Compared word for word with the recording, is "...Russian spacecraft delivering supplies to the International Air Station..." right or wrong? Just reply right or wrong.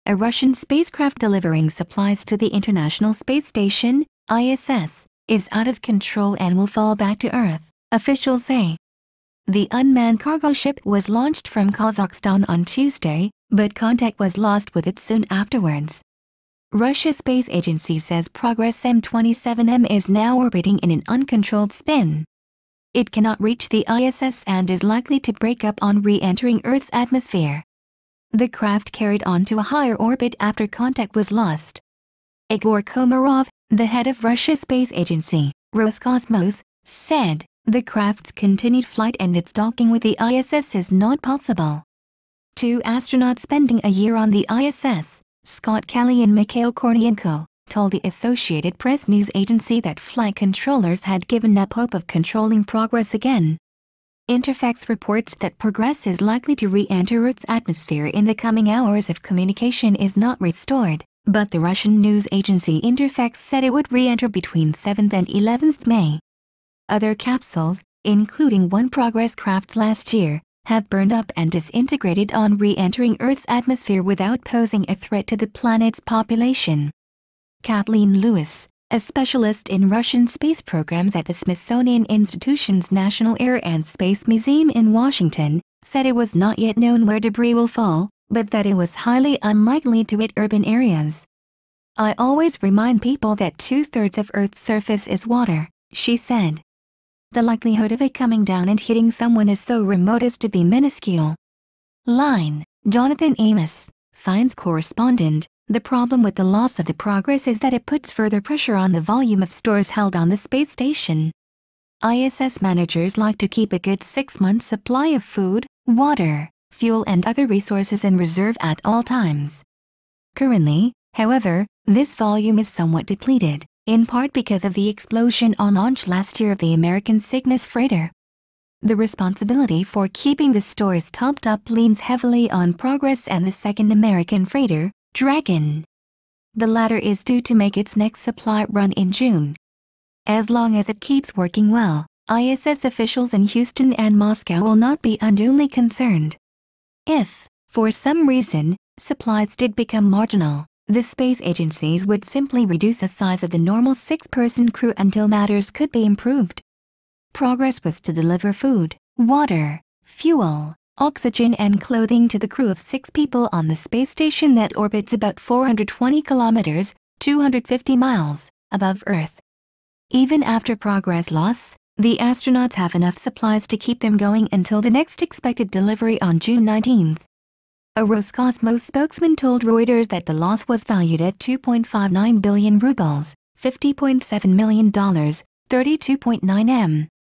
wrong.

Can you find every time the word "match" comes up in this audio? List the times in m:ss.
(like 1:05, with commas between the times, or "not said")
not said.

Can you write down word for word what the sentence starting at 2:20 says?
As long as it keeps working well, ISS officials in Houston and Moscow will not be unduly concerned.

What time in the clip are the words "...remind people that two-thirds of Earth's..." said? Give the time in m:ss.
1:32.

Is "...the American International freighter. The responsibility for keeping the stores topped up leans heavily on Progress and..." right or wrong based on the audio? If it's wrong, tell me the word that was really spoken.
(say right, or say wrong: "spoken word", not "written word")
wrong: "Cygnus", not "International".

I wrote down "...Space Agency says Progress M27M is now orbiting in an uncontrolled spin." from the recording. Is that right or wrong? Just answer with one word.
right.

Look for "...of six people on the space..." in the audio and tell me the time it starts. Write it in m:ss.
2:42.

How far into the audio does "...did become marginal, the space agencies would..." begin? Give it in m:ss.
2:29.